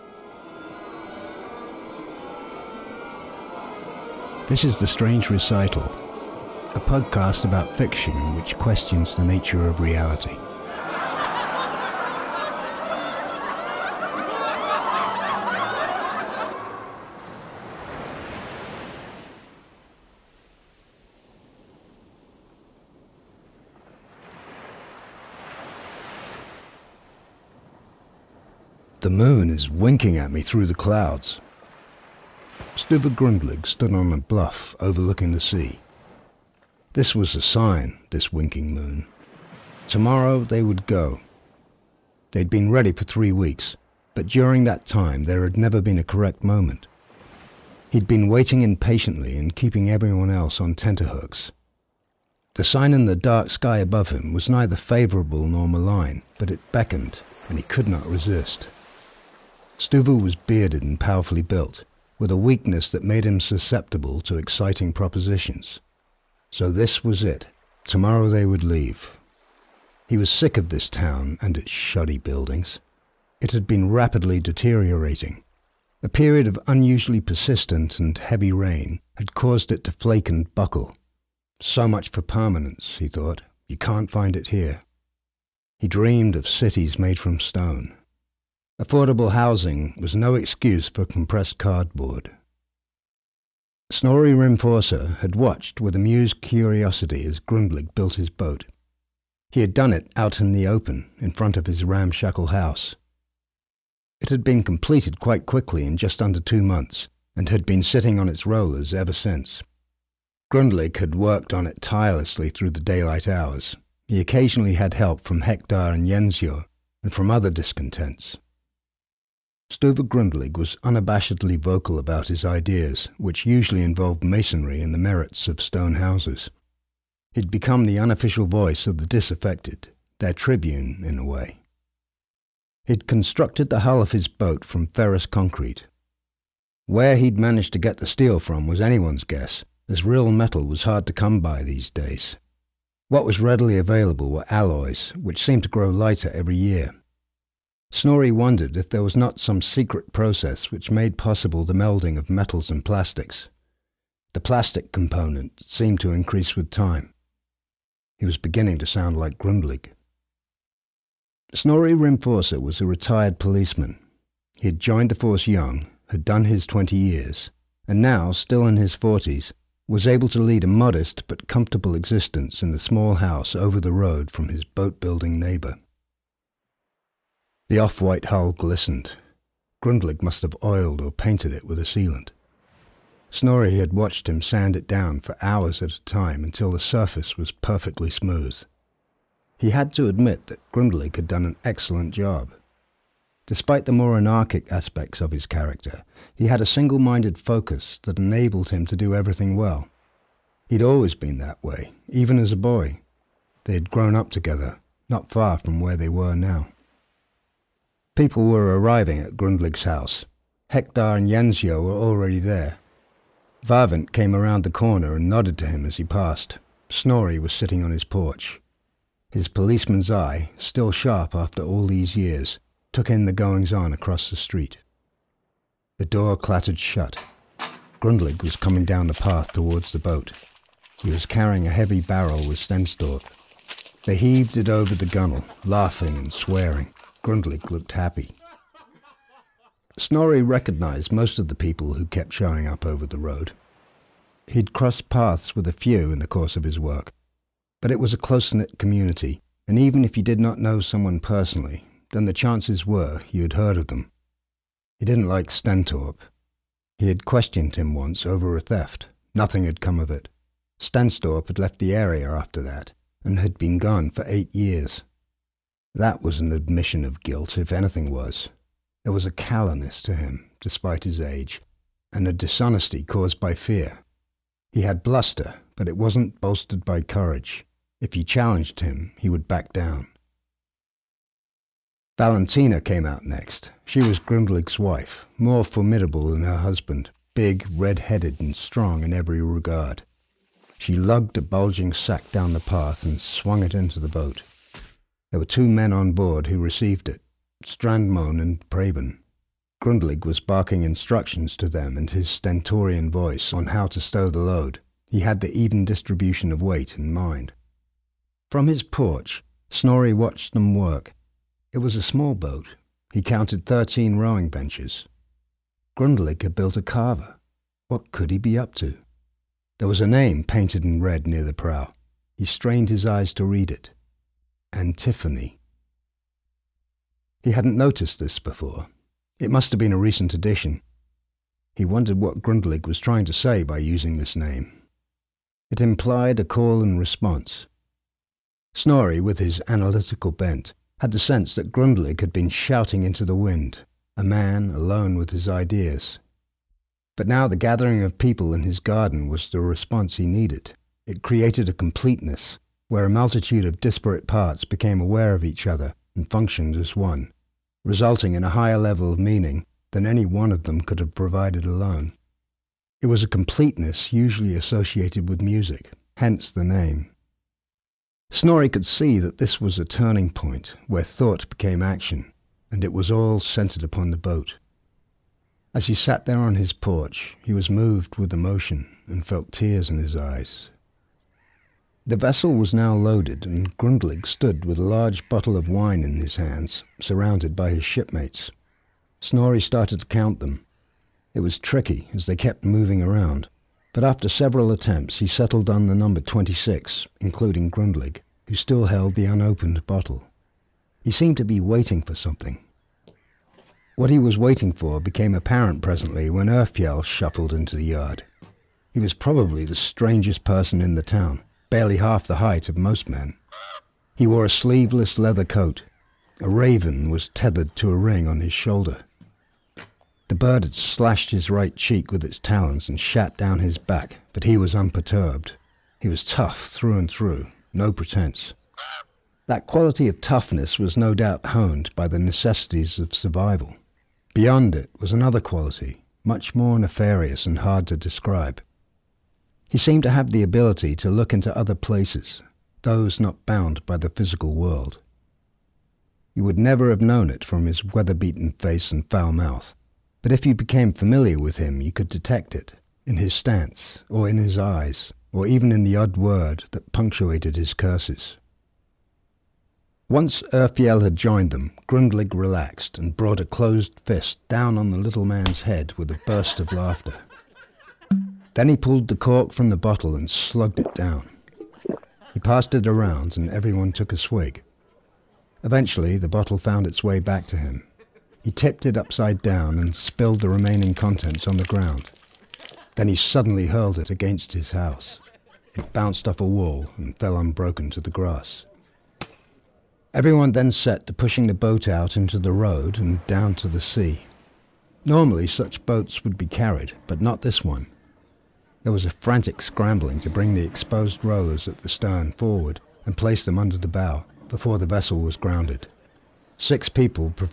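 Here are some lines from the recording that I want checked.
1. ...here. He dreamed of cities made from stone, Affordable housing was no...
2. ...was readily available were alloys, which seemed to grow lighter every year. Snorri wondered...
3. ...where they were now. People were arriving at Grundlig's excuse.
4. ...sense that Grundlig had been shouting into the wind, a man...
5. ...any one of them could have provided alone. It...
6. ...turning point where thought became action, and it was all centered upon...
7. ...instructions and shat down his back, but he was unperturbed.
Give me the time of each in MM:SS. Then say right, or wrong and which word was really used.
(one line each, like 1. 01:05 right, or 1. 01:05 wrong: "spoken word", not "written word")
1. 01:24 right
2. 02:23 right
3. 03:25 wrong: "house", not "excuse"
4. 05:41 right
5. 06:00 right
6. 06:09 right
7. 07:02 wrong: "talons", not "instructions".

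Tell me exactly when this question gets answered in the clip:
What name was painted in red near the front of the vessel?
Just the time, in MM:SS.
05:24.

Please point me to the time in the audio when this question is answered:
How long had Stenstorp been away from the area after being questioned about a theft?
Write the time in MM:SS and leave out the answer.
04:24.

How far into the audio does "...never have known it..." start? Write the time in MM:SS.
07:26.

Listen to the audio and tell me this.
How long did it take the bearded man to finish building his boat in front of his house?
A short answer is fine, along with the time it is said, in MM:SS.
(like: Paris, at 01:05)
Just under two months, at 01:45.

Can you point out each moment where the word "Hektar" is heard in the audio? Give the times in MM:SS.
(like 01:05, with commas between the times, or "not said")
01:55, 03:30.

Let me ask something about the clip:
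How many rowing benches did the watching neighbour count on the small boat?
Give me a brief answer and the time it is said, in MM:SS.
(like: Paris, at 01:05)
13, at 05:13.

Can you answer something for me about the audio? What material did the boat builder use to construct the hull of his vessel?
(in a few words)
Ferrous concrete.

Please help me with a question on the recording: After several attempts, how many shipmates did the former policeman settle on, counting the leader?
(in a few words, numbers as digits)
26.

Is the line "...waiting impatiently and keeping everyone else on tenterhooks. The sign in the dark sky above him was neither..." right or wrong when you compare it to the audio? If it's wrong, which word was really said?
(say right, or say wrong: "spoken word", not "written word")
right.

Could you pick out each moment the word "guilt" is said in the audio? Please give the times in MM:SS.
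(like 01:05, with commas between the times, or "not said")
04:27.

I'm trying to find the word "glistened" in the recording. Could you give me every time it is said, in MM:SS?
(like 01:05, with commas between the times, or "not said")
02:58.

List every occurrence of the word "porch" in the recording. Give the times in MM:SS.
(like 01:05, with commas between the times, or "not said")
03:38, 05:08, 06:16.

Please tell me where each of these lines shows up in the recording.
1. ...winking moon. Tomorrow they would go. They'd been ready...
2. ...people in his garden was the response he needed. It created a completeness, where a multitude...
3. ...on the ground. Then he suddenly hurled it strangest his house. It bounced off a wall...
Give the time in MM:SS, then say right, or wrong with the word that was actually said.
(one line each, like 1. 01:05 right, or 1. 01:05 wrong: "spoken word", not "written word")
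1. 00:38 right
2. 05:48 right
3. 08:01 wrong: "against", not "strangest".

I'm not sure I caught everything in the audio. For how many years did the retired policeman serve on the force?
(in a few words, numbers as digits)
20.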